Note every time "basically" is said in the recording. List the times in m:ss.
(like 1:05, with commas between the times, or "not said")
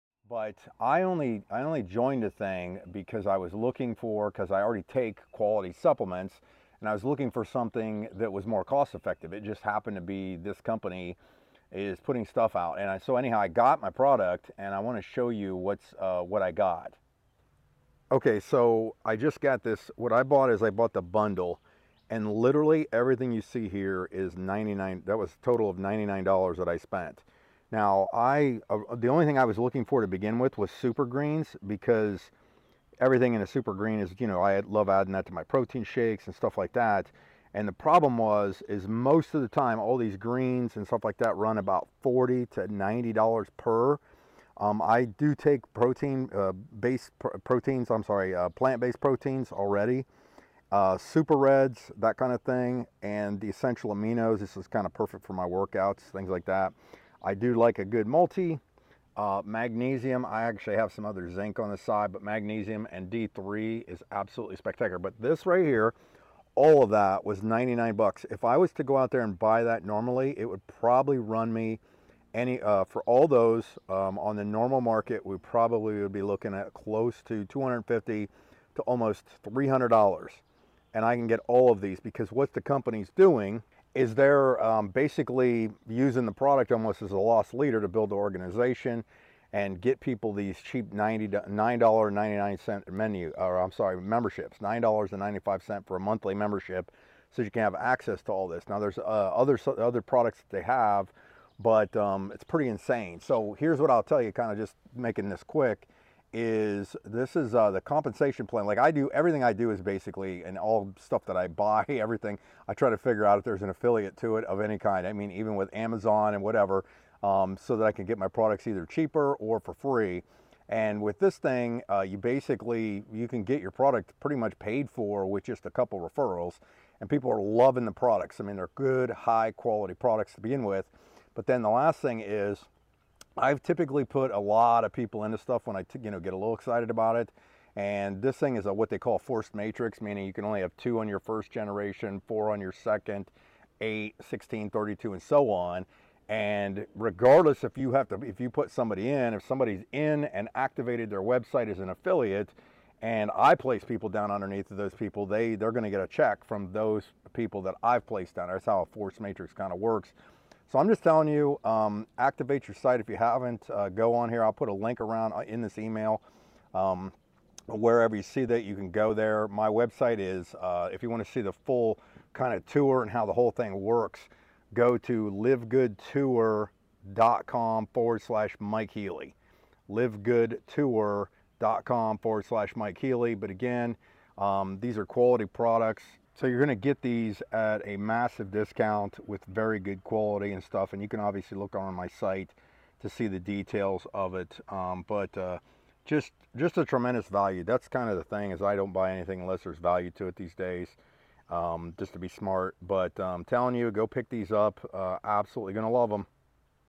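1:24, 1:49, 2:02.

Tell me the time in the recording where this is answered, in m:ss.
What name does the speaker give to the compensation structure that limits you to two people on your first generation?
2:19.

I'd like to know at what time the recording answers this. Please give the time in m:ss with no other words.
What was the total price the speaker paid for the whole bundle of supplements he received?
0:25.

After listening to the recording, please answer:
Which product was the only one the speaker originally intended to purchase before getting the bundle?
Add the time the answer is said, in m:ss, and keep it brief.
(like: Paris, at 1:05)
super greens, at 0:30.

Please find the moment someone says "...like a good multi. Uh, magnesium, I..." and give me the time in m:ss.
0:57.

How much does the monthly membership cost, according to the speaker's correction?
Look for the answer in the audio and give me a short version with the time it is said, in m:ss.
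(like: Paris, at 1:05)
$9.95, at 1:34.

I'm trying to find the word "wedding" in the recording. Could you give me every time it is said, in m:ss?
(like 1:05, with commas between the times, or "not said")
not said.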